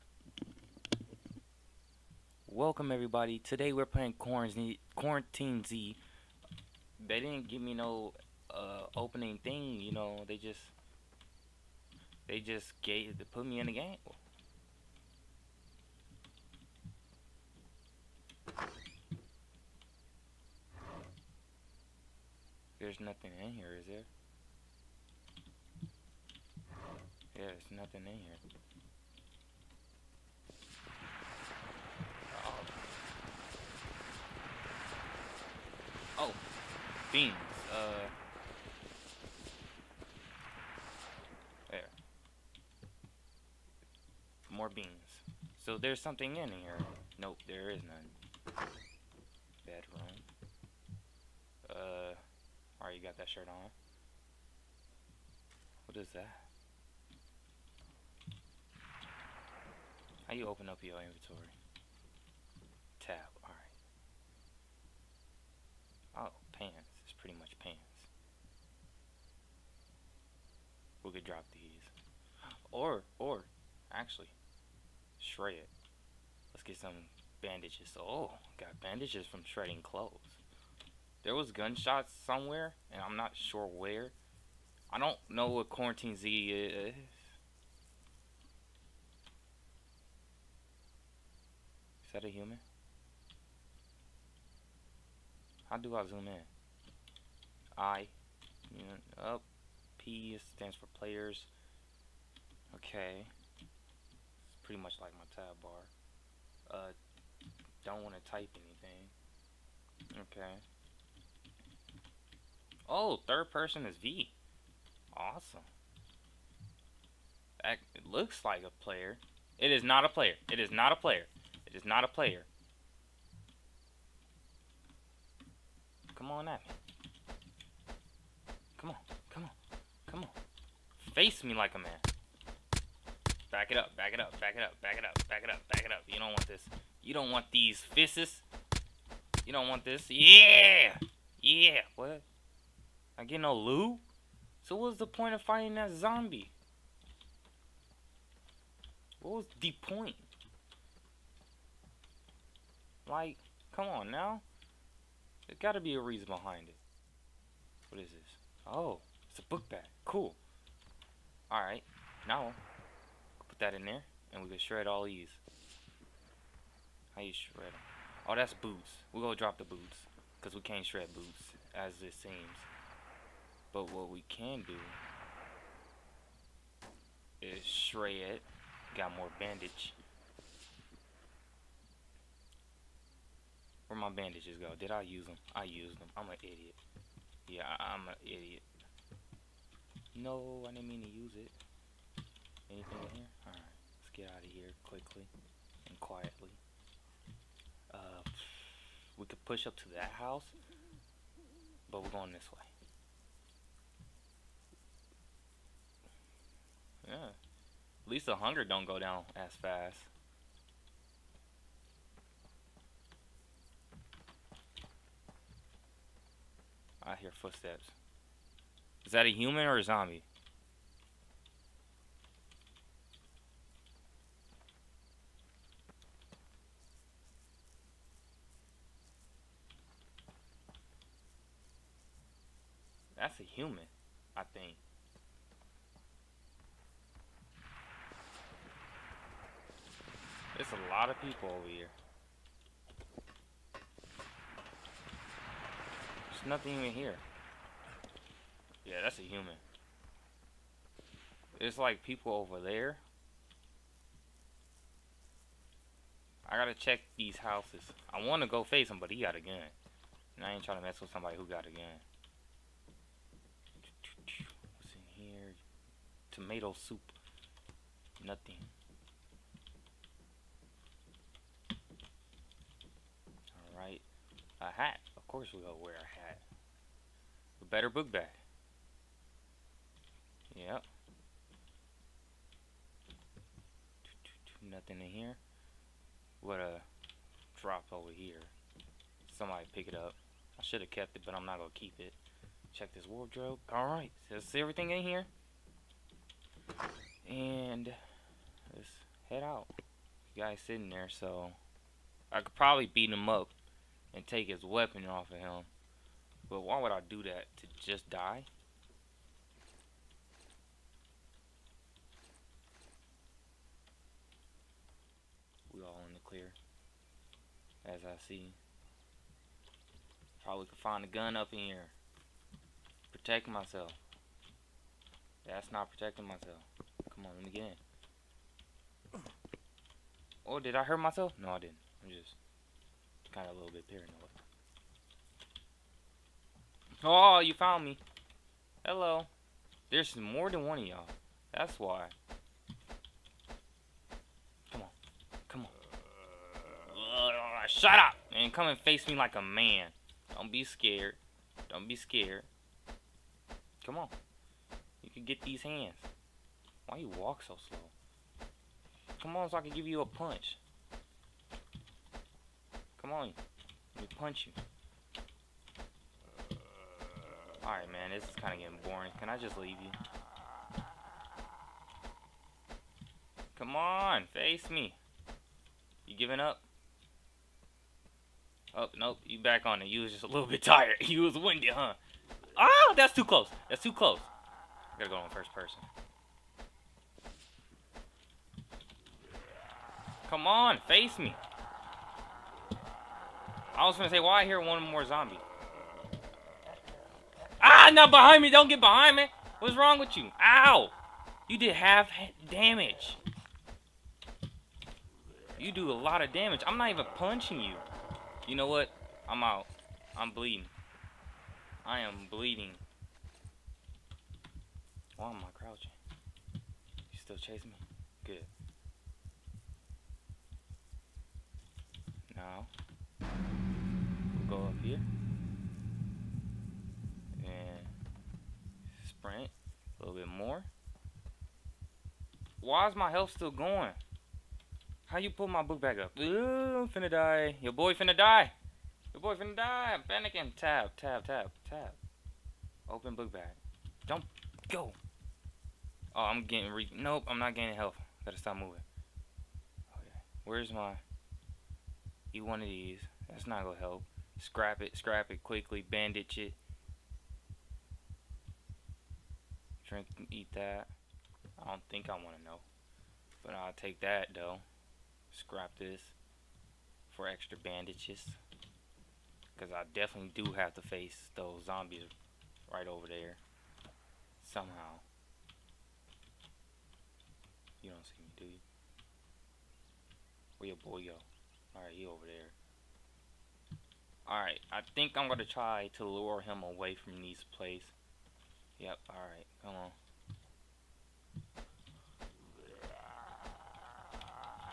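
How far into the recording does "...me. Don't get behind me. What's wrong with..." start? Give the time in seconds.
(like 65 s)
398 s.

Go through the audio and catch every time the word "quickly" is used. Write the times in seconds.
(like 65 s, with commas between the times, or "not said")
194 s, 455 s.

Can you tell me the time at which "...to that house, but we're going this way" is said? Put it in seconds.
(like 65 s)
199 s.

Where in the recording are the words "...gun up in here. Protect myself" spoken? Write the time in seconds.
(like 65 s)
321 s.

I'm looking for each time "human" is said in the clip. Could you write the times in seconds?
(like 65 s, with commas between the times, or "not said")
92 s, 219 s, 233 s, 249 s.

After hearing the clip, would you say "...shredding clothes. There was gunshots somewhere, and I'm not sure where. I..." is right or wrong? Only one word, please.
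right.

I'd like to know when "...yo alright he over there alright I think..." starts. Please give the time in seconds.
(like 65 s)
480 s.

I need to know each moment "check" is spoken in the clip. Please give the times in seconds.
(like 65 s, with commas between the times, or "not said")
256 s, 292 s.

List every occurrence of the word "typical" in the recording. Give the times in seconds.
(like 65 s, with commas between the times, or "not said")
not said.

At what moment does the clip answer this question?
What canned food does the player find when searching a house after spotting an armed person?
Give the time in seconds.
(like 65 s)
266 s.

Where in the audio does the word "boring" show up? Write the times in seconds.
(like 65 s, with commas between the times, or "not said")
368 s.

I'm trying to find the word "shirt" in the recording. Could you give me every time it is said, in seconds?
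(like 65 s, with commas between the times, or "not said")
53 s.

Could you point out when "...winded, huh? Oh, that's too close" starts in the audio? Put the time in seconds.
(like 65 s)
381 s.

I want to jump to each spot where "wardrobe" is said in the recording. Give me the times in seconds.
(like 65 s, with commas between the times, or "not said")
293 s.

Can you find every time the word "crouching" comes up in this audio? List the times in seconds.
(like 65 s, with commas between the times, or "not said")
415 s.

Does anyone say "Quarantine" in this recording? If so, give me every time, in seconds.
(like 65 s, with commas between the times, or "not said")
4 s, 85 s.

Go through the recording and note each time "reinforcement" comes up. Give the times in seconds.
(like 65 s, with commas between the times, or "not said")
not said.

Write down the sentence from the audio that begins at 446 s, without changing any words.
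Oh, I'm getting re- Nope, I'm not gaining health.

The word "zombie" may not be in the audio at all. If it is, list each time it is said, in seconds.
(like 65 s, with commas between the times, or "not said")
145 s, 219 s, 395 s, 471 s.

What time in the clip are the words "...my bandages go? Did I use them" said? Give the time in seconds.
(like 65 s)
183 s.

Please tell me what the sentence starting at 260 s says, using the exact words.
And I ain't trying to mess with somebody who got a gun.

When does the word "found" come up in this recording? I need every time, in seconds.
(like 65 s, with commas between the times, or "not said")
337 s.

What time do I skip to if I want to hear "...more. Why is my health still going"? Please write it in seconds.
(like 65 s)
430 s.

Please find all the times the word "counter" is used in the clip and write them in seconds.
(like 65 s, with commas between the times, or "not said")
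not said.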